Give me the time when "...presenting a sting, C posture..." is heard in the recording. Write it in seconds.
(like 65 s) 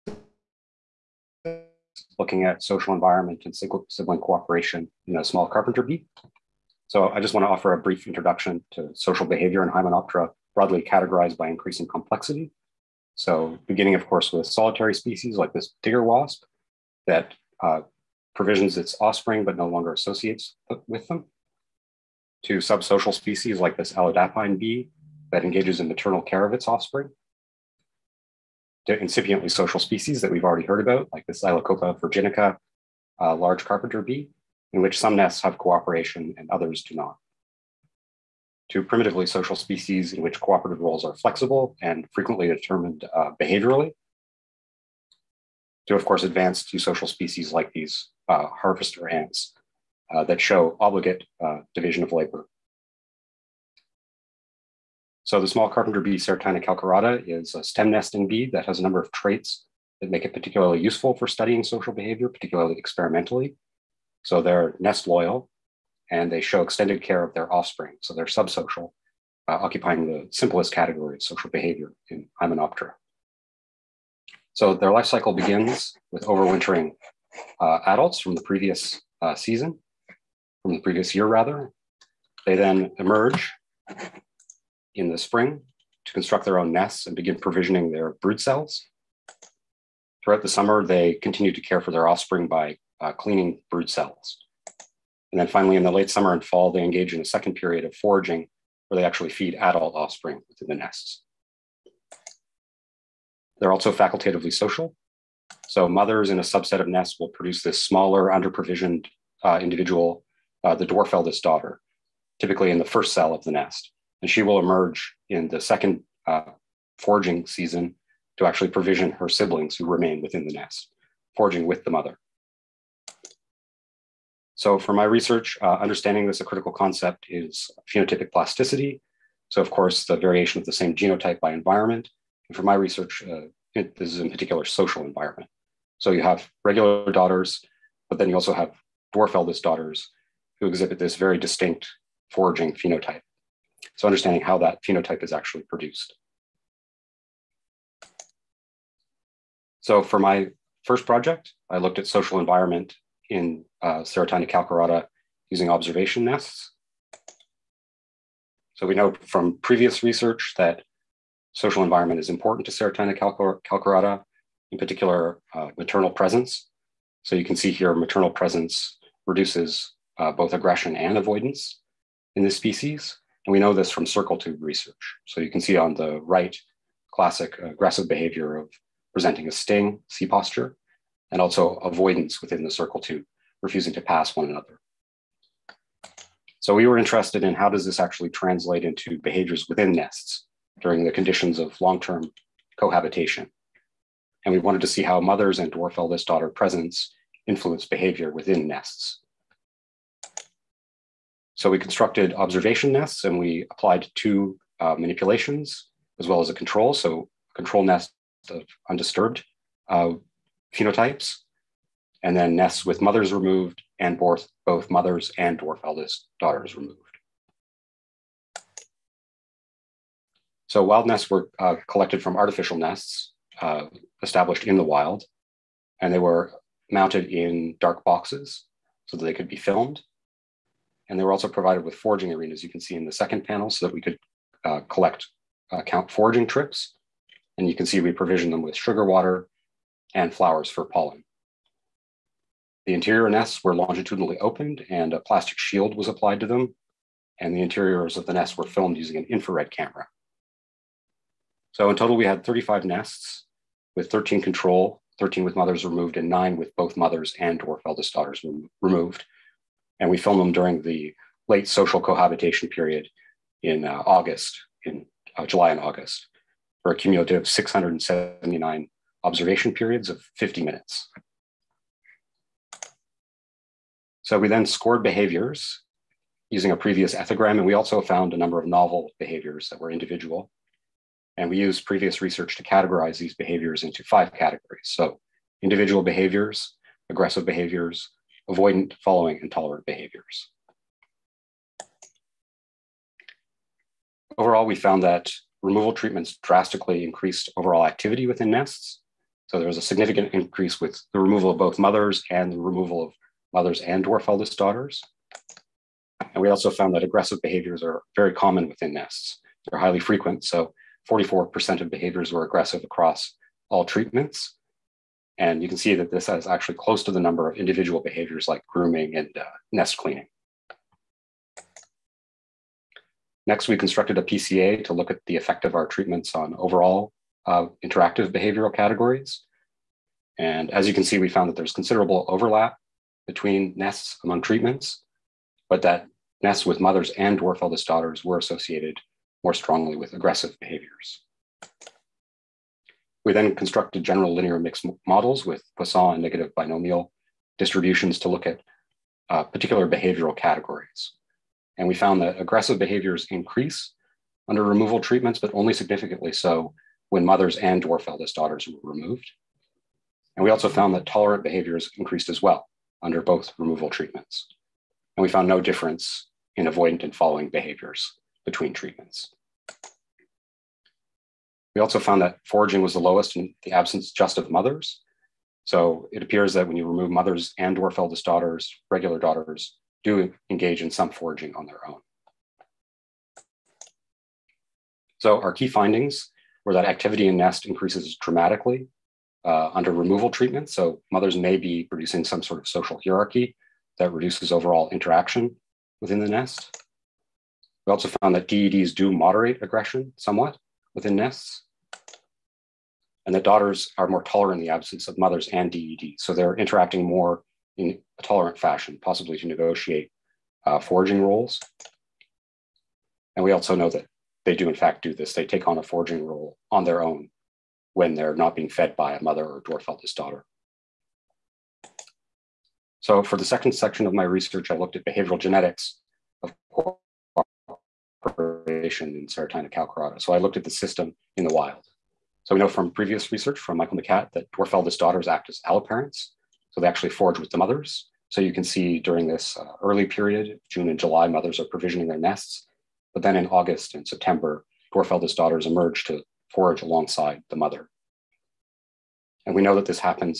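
179 s.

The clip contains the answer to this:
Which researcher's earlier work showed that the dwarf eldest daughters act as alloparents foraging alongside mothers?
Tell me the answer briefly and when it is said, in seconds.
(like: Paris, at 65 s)
Michael Mikát, at 433 s.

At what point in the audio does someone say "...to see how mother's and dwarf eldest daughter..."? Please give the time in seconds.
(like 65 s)
194 s.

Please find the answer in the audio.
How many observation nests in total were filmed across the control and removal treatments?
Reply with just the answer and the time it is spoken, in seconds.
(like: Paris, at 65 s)
35, at 252 s.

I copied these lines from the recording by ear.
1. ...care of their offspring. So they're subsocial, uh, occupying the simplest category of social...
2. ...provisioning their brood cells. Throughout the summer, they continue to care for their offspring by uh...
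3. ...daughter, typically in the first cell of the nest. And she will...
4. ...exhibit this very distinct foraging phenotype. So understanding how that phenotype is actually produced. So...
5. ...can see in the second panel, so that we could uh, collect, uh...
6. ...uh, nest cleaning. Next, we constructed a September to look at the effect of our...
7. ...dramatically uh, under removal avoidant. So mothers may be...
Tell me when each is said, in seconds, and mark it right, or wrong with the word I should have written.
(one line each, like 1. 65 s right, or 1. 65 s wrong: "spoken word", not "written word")
1. 67 s right
2. 87 s right
3. 111 s right
4. 140 s right
5. 232 s right
6. 319 s wrong: "PCA", not "September"
7. 388 s wrong: "treatment", not "avoidant".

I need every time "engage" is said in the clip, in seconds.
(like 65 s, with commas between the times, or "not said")
25 s, 96 s, 380 s.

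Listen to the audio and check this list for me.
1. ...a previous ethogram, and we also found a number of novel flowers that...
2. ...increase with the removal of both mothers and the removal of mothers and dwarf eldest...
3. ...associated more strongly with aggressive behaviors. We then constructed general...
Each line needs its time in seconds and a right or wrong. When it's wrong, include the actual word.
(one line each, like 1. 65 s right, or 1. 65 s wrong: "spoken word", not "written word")
1. 276 s wrong: "behaviors", not "flowers"
2. 300 s right
3. 338 s right.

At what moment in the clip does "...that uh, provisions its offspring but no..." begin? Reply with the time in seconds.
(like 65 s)
17 s.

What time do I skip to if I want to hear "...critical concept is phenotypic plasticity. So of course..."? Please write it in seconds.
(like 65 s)
126 s.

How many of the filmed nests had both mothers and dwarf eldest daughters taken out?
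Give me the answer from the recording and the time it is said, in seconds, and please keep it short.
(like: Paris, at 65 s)
9, at 256 s.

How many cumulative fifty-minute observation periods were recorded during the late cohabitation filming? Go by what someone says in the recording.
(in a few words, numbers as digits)
679.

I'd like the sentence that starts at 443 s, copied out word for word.
But then in August and September, dwarf eldest daughters emerge to forage alongside the mother.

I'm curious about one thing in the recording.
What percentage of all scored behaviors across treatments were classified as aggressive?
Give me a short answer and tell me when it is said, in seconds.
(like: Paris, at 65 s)
44%, at 311 s.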